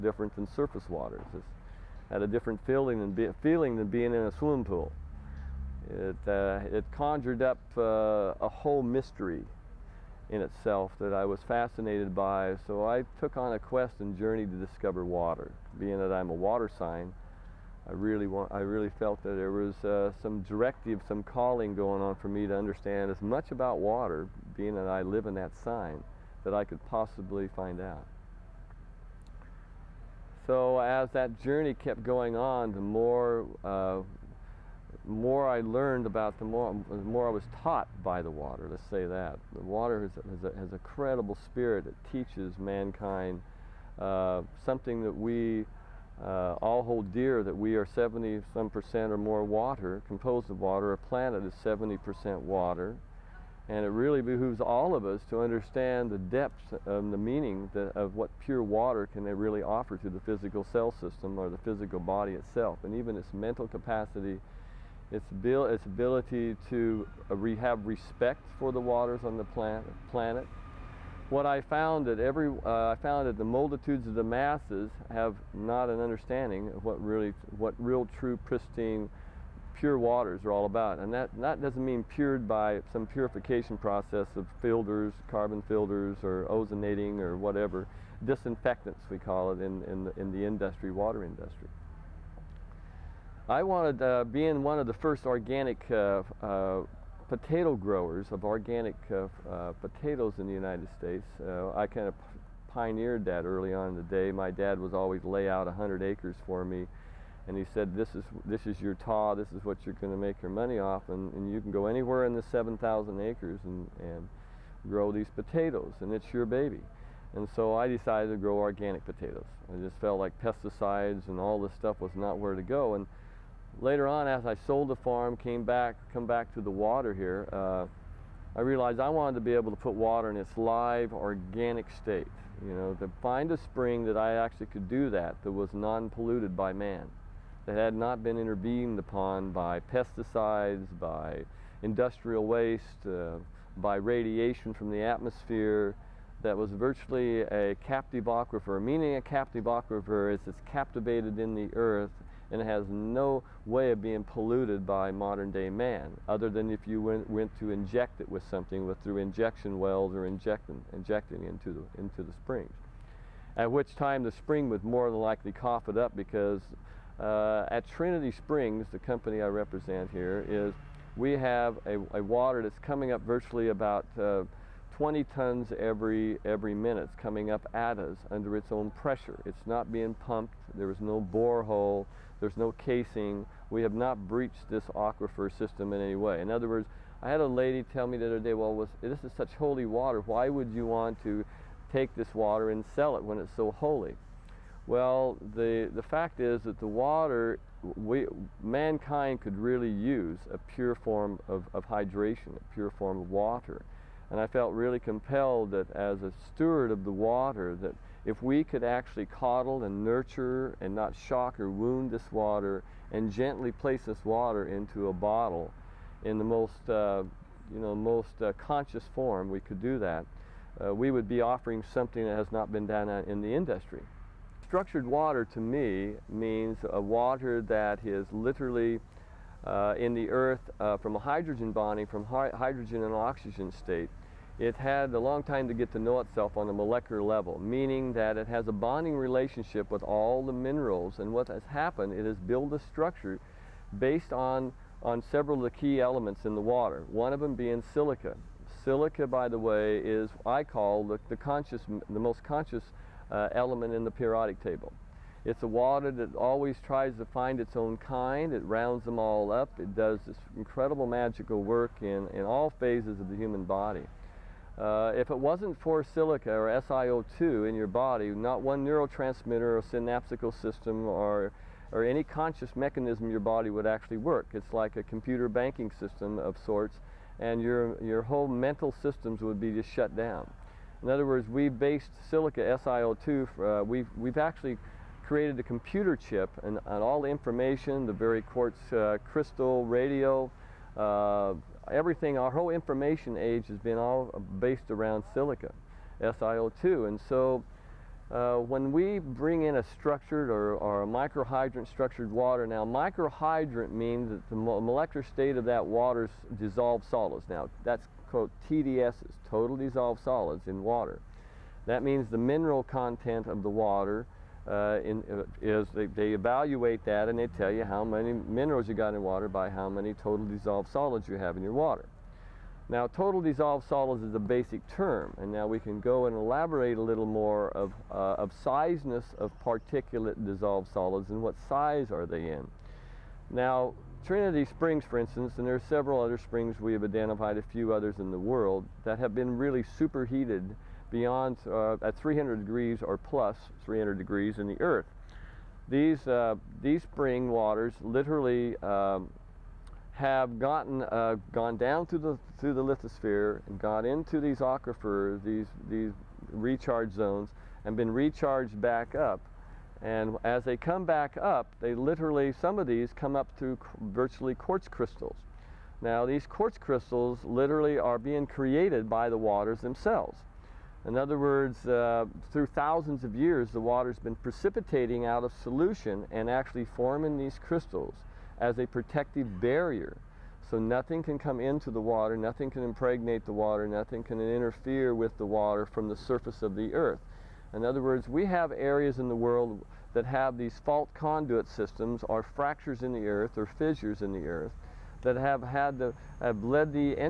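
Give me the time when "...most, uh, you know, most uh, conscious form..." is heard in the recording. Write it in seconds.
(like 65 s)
216 s.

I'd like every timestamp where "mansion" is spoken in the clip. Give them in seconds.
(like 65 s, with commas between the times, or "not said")
not said.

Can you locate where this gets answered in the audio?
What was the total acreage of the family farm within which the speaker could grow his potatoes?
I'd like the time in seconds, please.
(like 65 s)
112 s.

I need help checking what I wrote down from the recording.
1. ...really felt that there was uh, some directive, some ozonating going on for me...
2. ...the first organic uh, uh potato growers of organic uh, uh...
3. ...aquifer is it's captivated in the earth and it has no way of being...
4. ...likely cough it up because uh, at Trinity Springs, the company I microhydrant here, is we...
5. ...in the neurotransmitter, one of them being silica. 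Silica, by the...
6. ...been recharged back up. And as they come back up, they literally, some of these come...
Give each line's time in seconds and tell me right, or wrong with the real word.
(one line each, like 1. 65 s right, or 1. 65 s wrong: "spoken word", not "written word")
1. 18 s wrong: "calling", not "ozonating"
2. 94 s right
3. 149 s right
4. 165 s wrong: "represent", not "microhydrant"
5. 246 s wrong: "water", not "neurotransmitter"
6. 357 s right.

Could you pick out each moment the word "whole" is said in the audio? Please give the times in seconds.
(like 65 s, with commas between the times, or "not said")
8 s, 278 s, 292 s.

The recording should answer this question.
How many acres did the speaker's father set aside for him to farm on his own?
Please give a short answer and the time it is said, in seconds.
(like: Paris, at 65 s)
100, at 105 s.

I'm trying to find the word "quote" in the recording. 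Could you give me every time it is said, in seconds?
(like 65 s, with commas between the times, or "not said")
308 s.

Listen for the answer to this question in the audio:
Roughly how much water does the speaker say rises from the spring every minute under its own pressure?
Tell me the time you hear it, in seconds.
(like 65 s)
174 s.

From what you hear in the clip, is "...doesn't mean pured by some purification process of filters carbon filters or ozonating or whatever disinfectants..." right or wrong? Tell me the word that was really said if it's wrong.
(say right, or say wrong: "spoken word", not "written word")
right.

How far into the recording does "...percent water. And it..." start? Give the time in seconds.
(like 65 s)
51 s.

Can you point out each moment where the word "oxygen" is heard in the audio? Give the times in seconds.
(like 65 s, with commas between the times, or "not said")
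233 s.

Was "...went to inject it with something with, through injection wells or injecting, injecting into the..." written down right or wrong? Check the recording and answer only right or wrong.
right.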